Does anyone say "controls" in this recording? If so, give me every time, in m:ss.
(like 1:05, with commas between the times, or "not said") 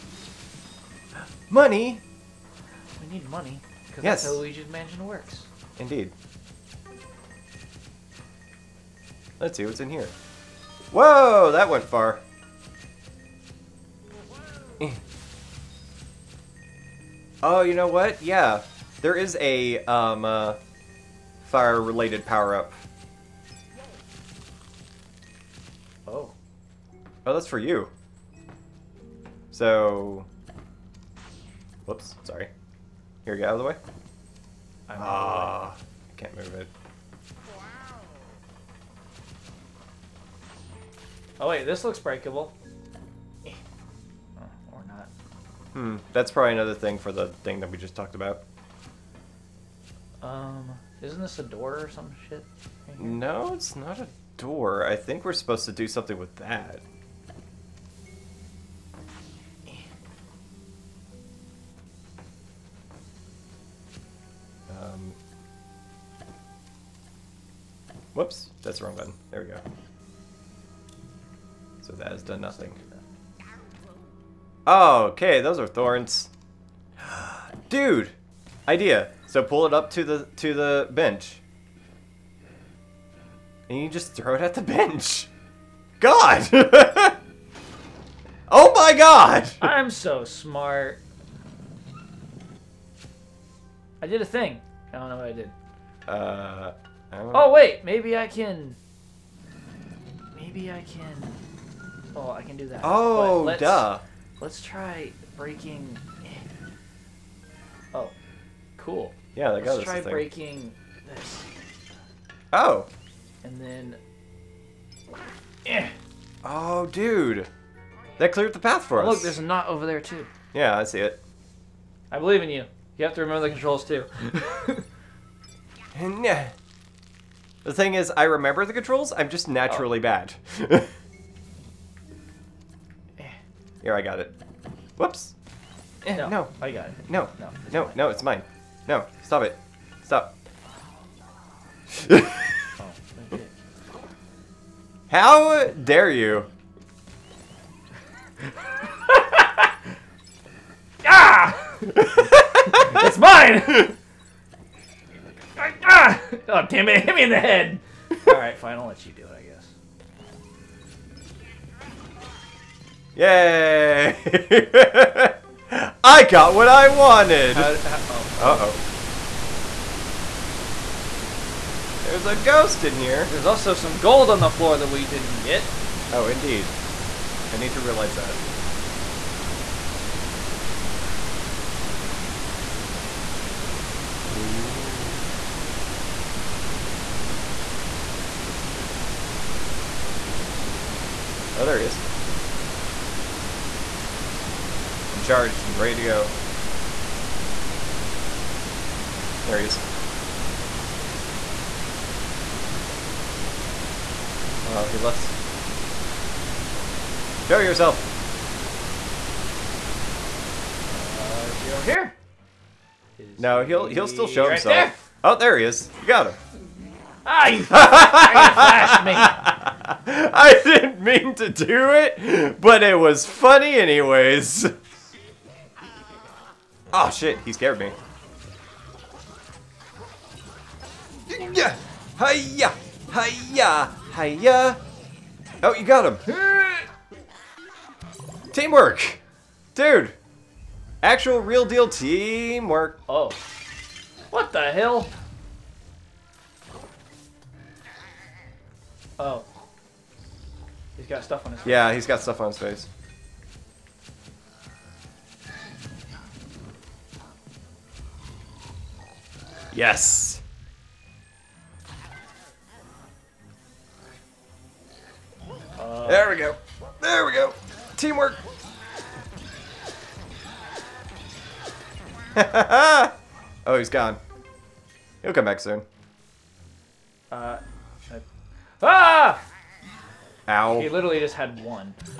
2:03, 2:08.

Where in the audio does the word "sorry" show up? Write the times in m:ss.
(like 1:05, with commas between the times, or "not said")
0:32.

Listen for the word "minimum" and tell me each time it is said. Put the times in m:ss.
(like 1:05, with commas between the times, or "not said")
not said.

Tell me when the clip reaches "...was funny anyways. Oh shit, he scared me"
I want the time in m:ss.
3:42.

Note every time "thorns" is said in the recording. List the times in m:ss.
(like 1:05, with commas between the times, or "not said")
1:15.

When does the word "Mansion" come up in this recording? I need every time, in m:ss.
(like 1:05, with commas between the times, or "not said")
0:04.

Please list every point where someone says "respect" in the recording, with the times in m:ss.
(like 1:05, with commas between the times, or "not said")
not said.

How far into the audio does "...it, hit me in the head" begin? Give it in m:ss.
2:36.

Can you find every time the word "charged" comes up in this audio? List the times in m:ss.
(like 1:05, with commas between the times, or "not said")
3:15.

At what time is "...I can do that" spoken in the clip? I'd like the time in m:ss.
1:42.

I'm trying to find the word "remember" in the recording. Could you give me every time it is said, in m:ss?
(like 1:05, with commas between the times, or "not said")
2:03, 2:08.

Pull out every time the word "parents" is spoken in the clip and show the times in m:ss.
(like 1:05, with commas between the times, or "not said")
not said.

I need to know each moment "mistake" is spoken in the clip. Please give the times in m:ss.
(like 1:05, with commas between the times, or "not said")
not said.